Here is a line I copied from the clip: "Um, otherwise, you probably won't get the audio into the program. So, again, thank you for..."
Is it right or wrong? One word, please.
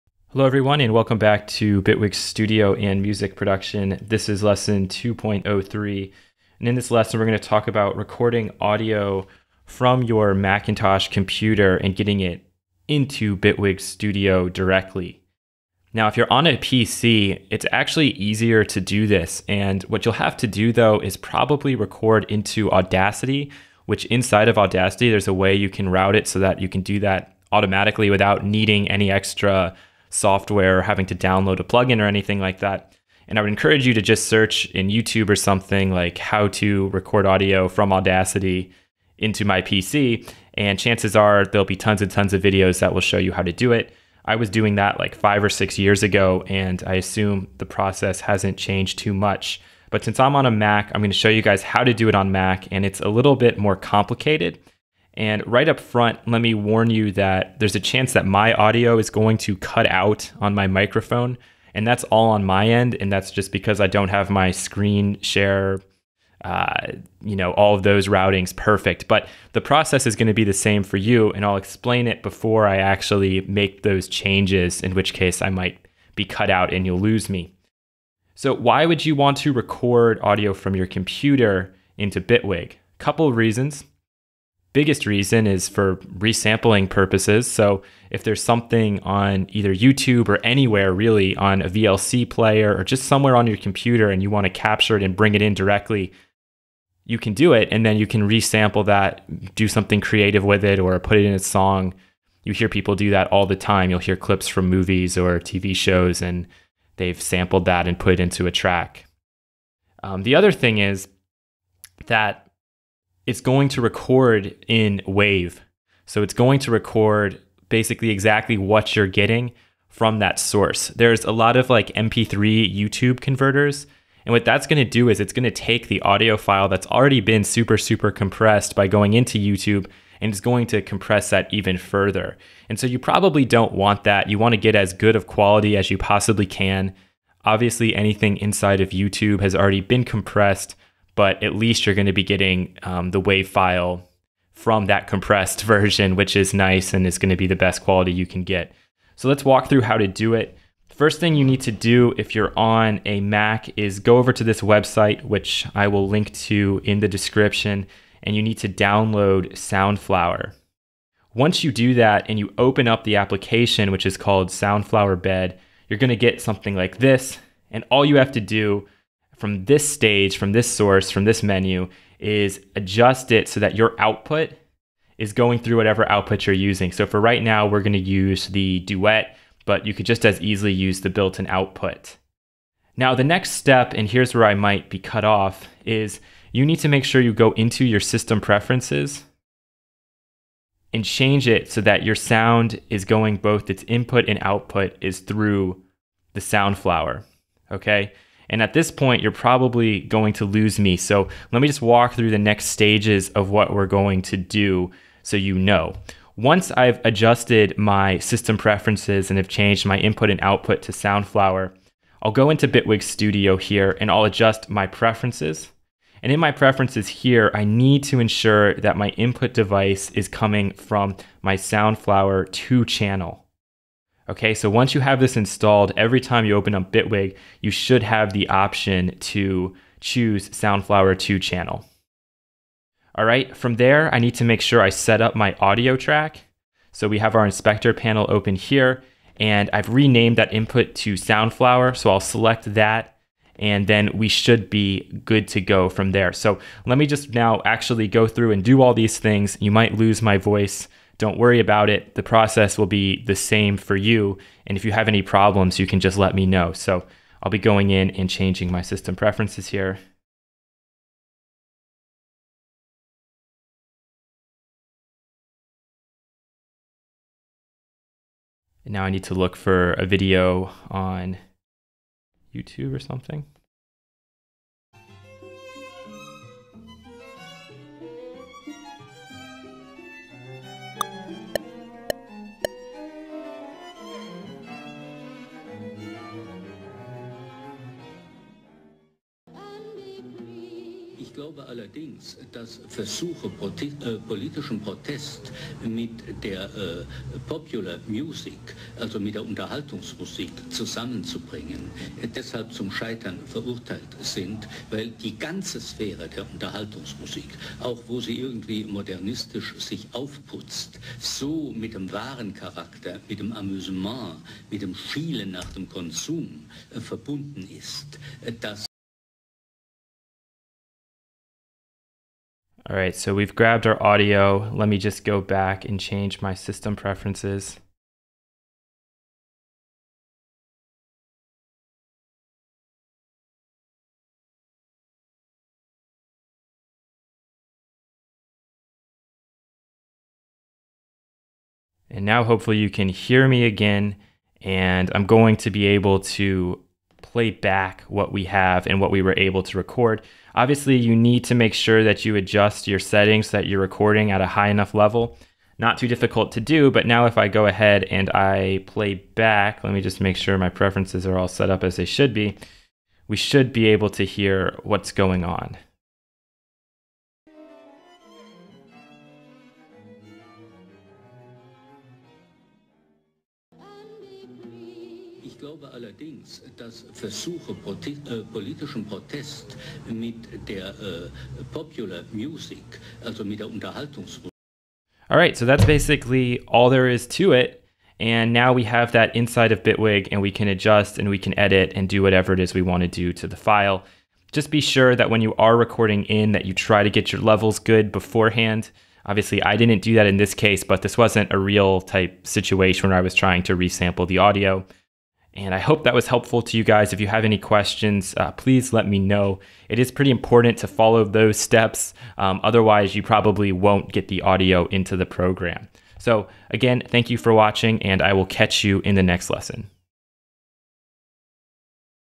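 right.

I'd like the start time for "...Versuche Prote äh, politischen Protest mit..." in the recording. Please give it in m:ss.
6:17.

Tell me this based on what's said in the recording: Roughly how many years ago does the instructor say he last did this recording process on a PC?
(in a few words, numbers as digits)
5 or 6 years.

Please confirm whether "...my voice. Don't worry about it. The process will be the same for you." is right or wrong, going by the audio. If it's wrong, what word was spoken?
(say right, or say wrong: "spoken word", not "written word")
right.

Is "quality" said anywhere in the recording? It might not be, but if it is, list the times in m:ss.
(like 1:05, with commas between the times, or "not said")
2:15, 2:27.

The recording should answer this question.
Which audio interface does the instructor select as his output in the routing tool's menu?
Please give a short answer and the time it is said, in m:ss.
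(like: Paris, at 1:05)
Duet, at 2:58.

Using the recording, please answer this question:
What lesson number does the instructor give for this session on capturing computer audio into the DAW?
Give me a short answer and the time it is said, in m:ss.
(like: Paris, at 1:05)
2.03, at 0:04.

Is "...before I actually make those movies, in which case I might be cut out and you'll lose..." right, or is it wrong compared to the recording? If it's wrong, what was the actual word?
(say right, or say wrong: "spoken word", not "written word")
wrong: "changes", not "movies".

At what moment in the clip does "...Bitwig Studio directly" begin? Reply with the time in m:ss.
0:13.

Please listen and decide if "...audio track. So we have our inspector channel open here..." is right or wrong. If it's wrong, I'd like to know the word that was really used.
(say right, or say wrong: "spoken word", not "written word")
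wrong: "panel", not "channel".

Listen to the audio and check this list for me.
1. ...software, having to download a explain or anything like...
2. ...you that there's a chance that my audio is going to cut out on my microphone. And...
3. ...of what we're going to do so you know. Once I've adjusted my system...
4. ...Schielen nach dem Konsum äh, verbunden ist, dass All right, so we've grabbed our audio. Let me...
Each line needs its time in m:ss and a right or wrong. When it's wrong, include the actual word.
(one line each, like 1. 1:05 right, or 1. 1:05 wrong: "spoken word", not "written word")
1. 0:30 wrong: "plugin", not "explain"
2. 0:56 right
3. 3:23 right
4. 5:14 right.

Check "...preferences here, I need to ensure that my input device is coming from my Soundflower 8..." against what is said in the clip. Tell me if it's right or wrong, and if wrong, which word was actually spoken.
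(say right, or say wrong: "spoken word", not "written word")
wrong: "2", not "8".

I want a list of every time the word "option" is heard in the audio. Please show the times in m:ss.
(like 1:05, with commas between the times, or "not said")
3:48.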